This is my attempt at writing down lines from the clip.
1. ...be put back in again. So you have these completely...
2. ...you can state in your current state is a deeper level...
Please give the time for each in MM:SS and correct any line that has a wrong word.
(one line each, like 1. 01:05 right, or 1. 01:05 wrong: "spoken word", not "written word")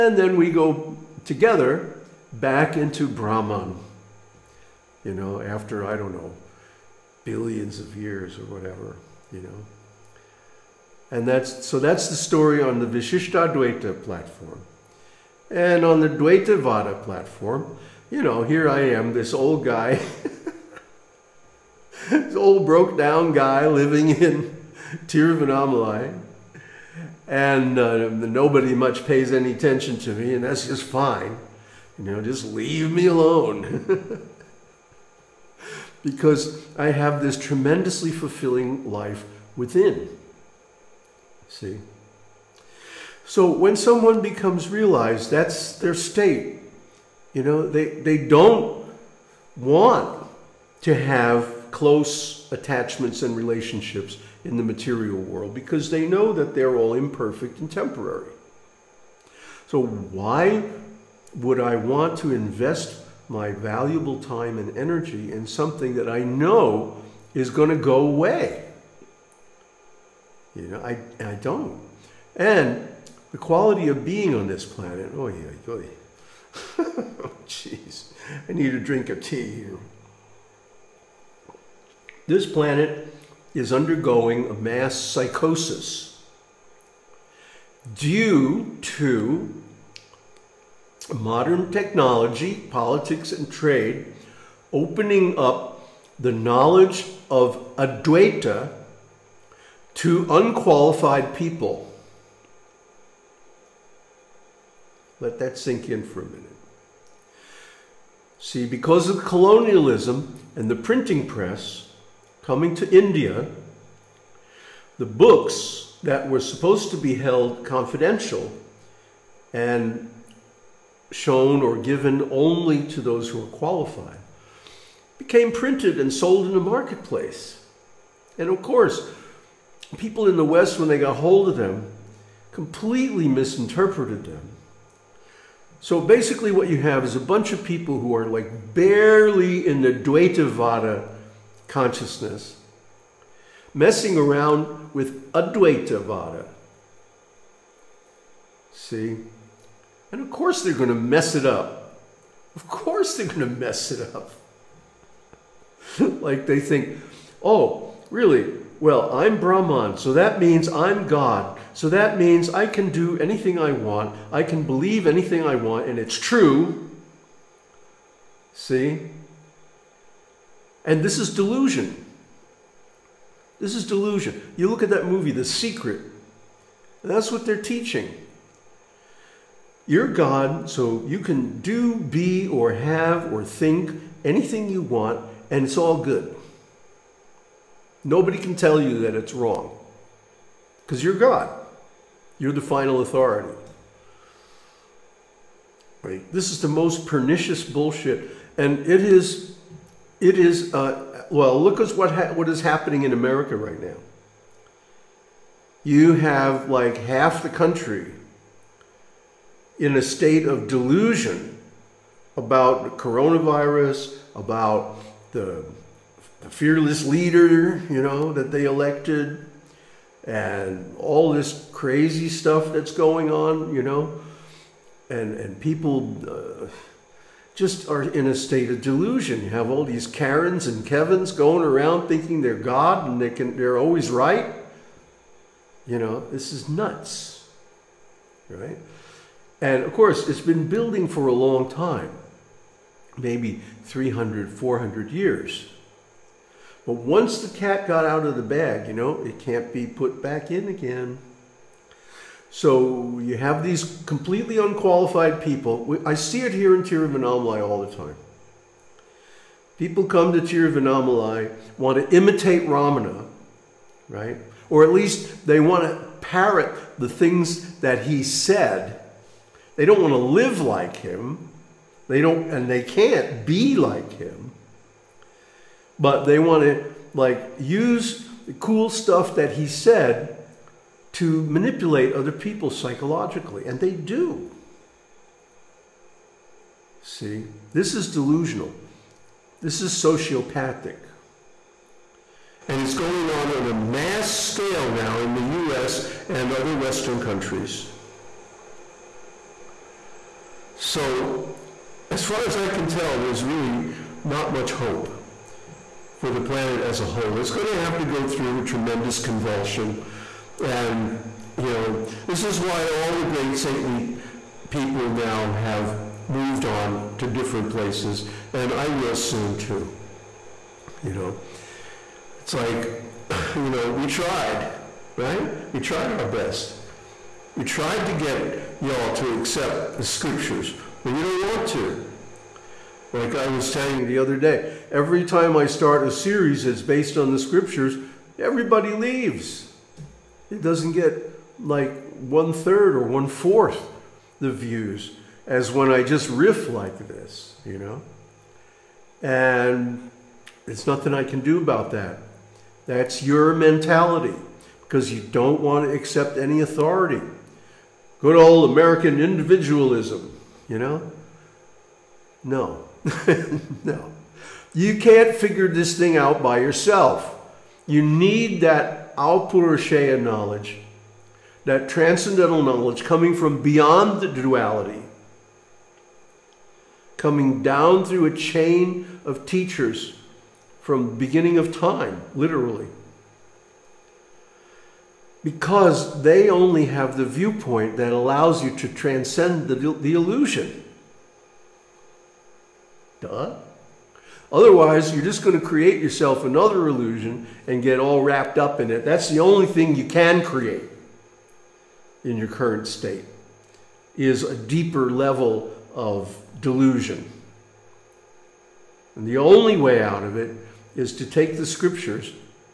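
1. 04:09 right
2. 06:39 wrong: "create", not "state".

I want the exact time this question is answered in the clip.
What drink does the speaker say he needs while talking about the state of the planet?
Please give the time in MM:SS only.
01:19.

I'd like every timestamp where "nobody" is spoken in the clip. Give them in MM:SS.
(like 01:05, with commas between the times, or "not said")
00:28, 03:08.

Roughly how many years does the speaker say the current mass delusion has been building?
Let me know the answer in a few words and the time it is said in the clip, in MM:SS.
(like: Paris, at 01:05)
300 to 400 years, at 04:03.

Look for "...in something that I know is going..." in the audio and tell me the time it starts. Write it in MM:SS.
01:05.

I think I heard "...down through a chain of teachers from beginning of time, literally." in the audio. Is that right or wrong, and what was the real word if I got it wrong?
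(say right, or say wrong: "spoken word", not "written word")
right.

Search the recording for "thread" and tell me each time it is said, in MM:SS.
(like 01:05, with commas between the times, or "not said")
not said.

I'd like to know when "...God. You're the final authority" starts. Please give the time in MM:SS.
03:11.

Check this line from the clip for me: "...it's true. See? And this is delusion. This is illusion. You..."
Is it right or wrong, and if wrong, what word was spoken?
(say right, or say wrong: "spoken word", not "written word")
wrong: "delusion", not "illusion".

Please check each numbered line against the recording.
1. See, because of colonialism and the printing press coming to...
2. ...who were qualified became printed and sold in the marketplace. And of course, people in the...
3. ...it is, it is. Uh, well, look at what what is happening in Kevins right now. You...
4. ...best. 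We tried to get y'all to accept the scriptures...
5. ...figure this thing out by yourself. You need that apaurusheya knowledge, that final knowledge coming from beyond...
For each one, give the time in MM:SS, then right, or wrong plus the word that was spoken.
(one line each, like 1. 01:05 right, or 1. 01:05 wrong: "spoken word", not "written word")
1. 01:48 right
2. 02:03 right
3. 03:18 wrong: "America", not "Kevins"
4. 05:26 right
5. 06:05 wrong: "transcendental", not "final".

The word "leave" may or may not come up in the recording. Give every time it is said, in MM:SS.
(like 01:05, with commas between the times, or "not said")
00:32, 05:38.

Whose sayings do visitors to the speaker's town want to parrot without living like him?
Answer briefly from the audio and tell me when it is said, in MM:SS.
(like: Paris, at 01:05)
Ramana, at 04:22.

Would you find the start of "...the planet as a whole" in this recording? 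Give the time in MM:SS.
05:06.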